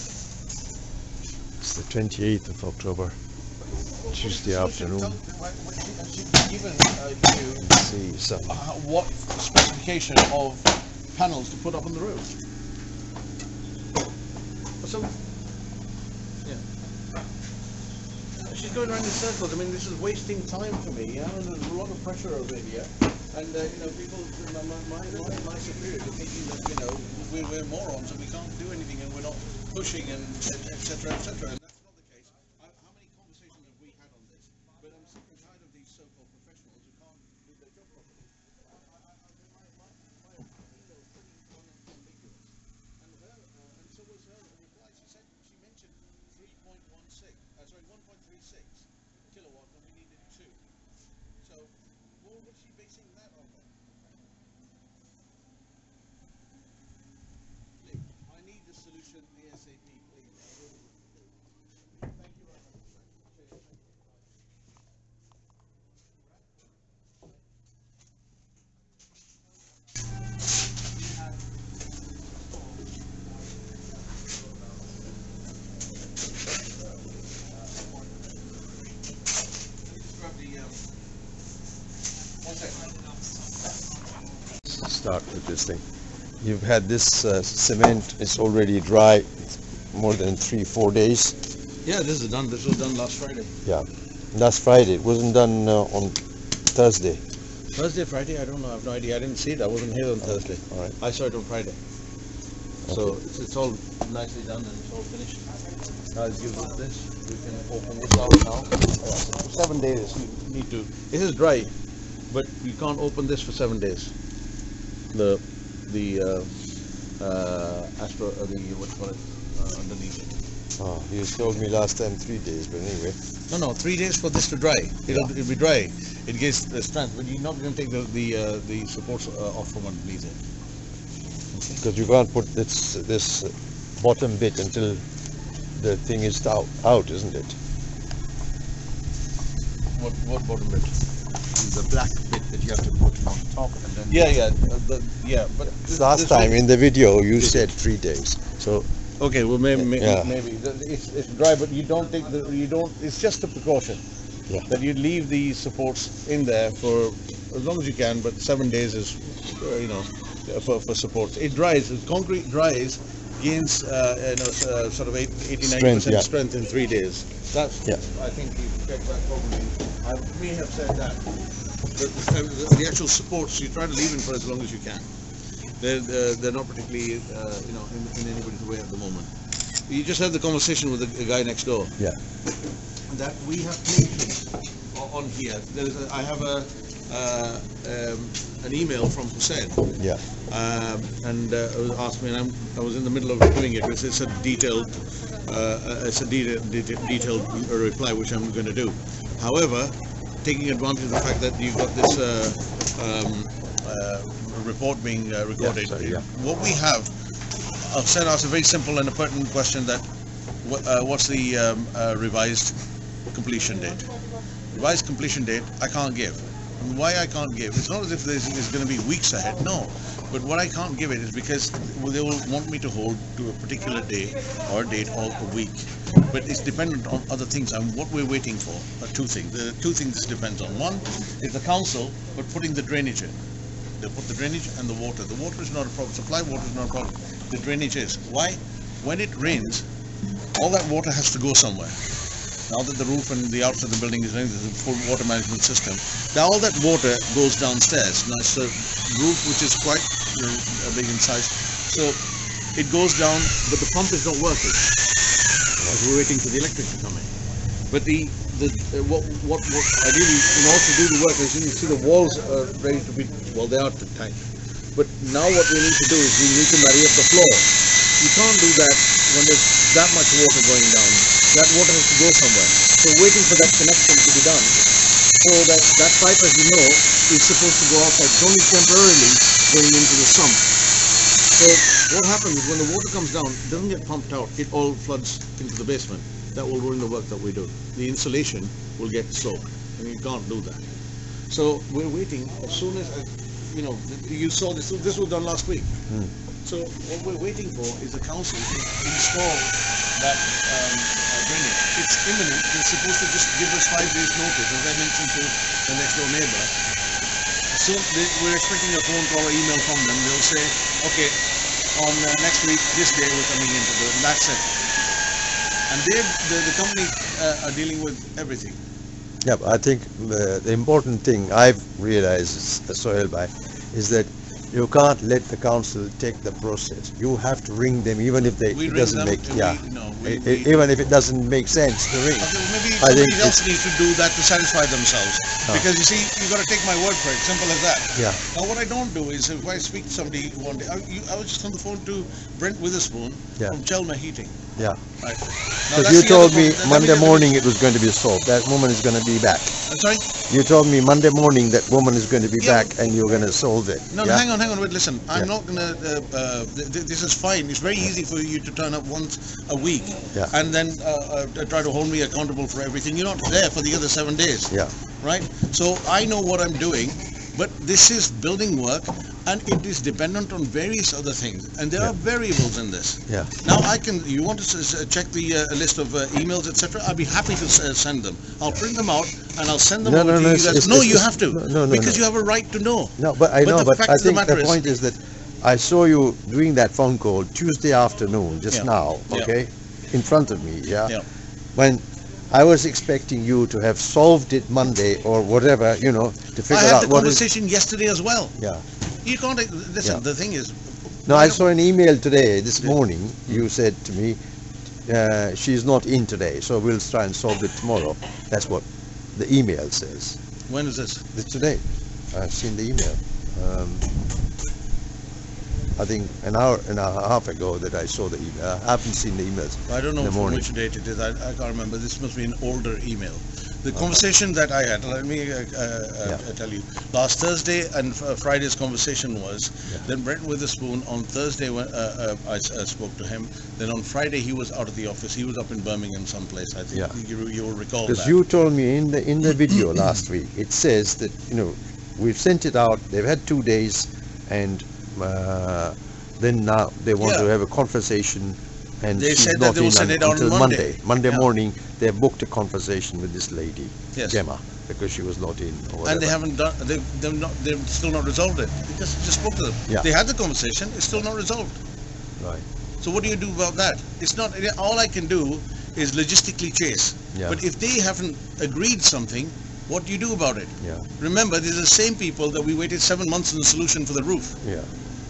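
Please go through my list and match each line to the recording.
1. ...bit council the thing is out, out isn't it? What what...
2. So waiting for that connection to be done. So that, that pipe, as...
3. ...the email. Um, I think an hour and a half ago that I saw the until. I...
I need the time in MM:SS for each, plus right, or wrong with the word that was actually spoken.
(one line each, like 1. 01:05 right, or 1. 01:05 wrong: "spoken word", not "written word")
1. 02:14 wrong: "until", not "council"
2. 04:33 right
3. 06:52 wrong: "email", not "until".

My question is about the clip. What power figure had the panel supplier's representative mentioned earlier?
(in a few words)
1.36 kilowatt.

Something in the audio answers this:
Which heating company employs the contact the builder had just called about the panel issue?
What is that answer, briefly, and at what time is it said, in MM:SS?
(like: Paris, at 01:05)
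Chelmer Heating, at 05:43.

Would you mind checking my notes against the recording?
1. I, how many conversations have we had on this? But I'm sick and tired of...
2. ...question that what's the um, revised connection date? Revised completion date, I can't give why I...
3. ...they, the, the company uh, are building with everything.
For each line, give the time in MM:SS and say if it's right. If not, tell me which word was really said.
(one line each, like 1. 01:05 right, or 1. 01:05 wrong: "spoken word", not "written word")
1. 00:32 right
2. 03:29 wrong: "completion", not "connection"
3. 05:16 wrong: "dealing", not "building".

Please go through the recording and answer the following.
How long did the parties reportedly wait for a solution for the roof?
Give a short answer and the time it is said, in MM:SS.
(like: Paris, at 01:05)
7 months, at 07:53.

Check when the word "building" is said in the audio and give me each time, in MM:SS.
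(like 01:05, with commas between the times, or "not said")
04:04, 06:08.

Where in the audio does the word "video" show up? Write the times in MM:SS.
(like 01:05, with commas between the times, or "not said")
02:26, 07:19.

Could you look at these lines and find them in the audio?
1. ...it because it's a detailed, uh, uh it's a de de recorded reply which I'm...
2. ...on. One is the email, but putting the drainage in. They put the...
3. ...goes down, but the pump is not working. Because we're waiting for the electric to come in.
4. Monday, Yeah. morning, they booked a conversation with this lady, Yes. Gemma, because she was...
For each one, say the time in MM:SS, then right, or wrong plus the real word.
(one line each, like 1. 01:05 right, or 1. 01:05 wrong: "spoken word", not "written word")
1. 03:13 wrong: "detailed", not "recorded"
2. 03:50 wrong: "council", not "email"
3. 04:12 right
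4. 07:31 right.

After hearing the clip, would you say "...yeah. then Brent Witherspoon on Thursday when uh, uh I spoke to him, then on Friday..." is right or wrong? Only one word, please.
right.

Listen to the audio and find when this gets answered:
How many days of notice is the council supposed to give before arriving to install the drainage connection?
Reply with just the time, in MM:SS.
05:03.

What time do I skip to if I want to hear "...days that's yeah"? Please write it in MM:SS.
02:46.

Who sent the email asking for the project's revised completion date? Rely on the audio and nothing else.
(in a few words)
Hussein.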